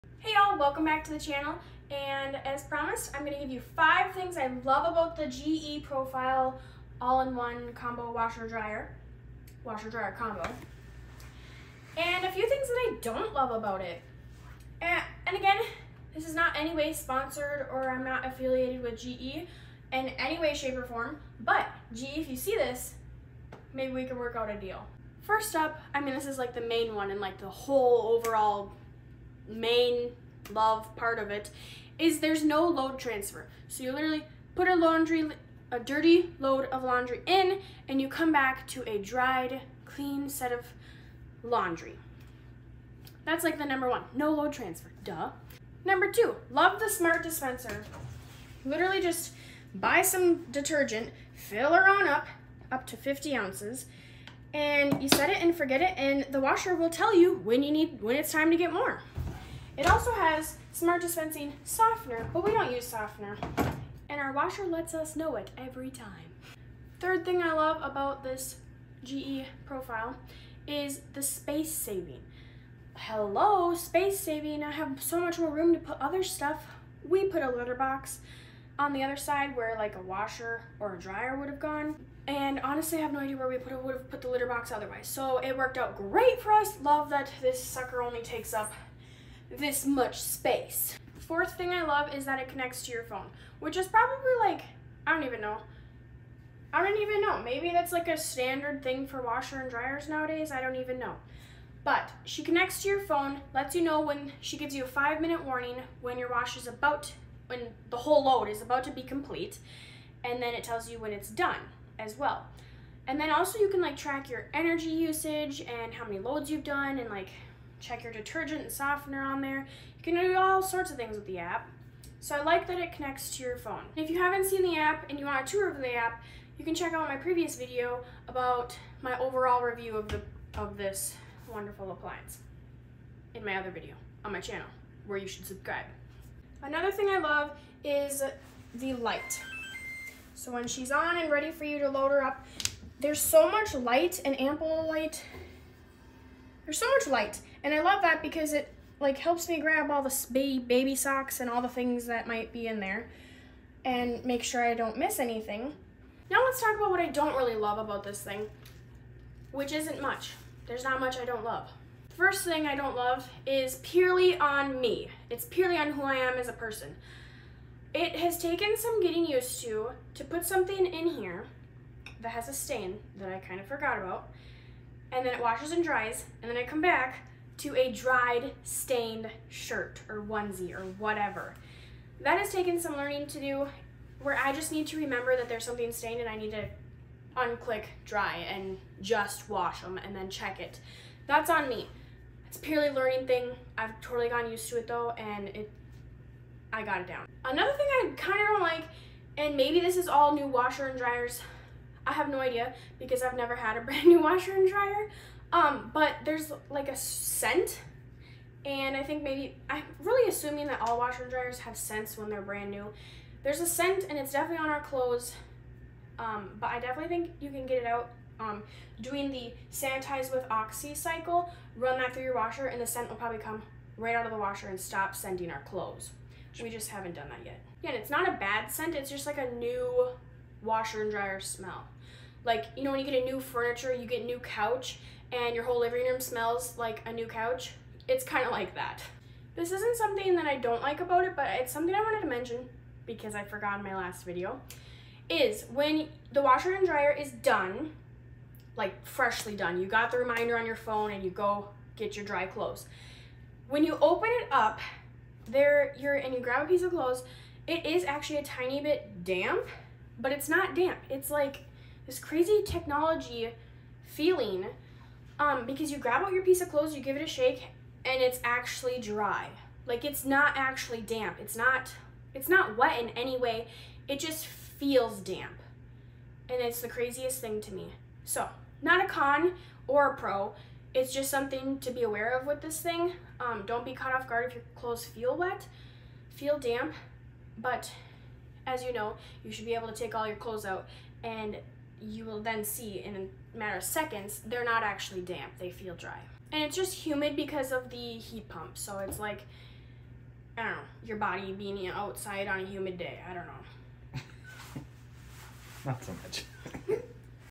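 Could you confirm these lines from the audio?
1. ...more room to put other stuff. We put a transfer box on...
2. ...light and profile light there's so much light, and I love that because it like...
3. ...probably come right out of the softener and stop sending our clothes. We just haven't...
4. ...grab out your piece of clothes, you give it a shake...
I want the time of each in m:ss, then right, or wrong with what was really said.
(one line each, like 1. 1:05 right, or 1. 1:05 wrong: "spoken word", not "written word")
1. 1:15 wrong: "litter", not "transfer"
2. 2:23 wrong: "ample", not "profile"
3. 3:43 wrong: "washer", not "softener"
4. 4:25 right.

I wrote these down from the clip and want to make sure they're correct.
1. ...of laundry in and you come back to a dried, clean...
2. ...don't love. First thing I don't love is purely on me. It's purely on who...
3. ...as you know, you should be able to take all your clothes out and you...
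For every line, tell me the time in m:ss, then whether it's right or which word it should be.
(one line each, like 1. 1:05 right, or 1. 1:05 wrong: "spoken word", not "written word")
1. 0:36 right
2. 2:41 right
3. 4:48 right.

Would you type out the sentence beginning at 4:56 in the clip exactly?
And it's just humid because of the heat pump.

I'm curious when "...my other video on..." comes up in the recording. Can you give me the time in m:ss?
2:13.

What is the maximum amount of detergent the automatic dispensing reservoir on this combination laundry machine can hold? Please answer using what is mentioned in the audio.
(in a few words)
50 ounces.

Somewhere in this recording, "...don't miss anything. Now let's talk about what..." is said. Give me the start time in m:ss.
2:34.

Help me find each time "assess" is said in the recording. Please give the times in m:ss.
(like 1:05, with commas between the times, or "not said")
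not said.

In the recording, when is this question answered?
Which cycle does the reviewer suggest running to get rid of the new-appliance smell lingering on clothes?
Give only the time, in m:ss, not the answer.
3:39.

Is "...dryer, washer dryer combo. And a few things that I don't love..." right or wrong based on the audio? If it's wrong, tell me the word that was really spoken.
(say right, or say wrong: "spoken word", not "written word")
right.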